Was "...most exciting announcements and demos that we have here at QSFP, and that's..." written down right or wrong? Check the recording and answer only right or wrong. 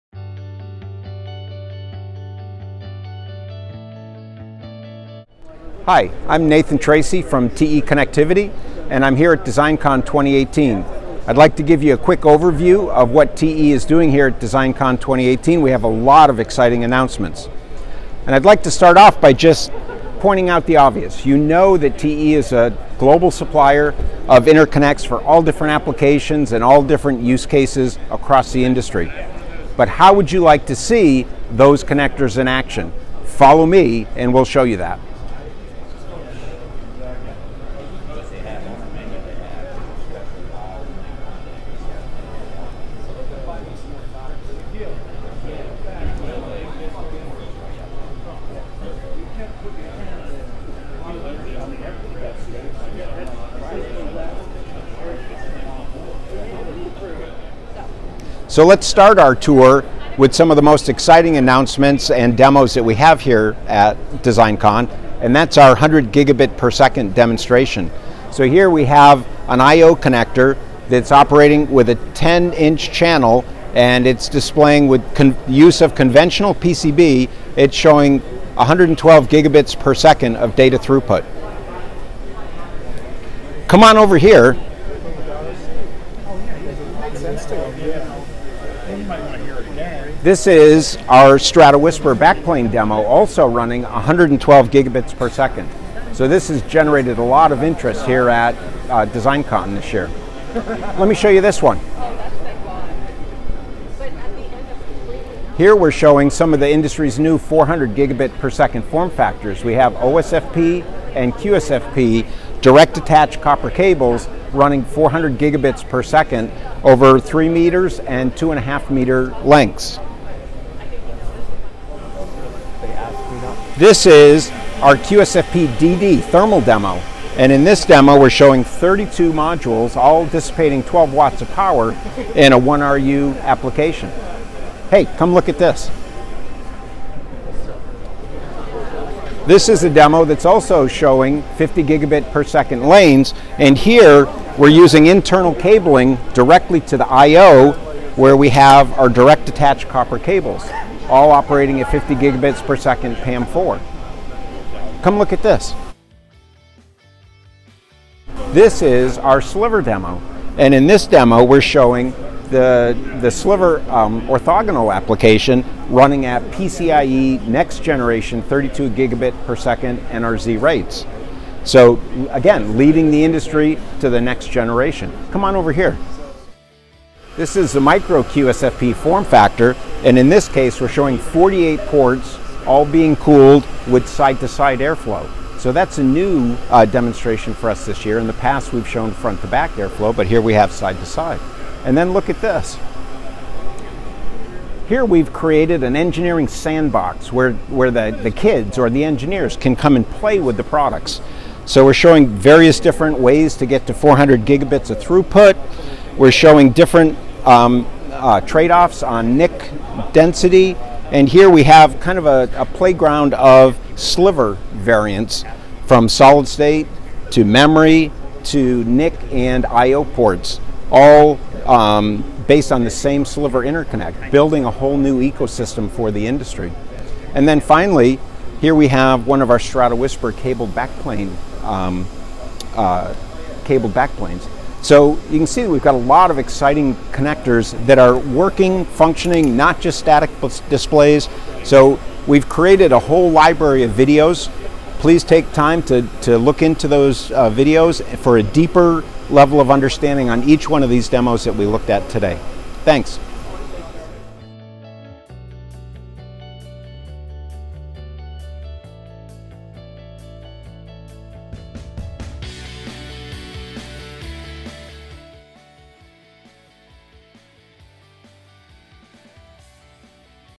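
wrong.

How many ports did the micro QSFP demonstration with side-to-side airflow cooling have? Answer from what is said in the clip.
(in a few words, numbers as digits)
48.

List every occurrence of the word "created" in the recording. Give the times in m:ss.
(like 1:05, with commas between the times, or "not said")
3:15, 4:02.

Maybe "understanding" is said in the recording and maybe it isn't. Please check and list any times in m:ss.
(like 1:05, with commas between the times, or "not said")
4:09.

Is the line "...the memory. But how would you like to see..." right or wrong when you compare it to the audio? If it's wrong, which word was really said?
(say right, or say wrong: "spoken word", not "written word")
wrong: "industry", not "memory".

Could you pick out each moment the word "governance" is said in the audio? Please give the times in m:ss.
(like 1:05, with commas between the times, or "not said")
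not said.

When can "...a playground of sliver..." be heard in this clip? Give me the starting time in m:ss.
3:32.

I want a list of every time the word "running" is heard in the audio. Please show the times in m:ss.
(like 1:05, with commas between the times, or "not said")
1:33, 1:54, 2:45.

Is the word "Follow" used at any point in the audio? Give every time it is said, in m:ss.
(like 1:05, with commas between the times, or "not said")
0:33.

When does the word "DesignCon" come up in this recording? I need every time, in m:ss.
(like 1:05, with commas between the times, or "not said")
0:09, 0:14, 1:04, 1:39.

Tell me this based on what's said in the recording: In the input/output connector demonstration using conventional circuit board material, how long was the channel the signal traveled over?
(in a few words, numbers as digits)
10 inch.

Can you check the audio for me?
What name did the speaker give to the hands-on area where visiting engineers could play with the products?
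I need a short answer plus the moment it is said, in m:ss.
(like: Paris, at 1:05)
engineering sandbox, at 3:15.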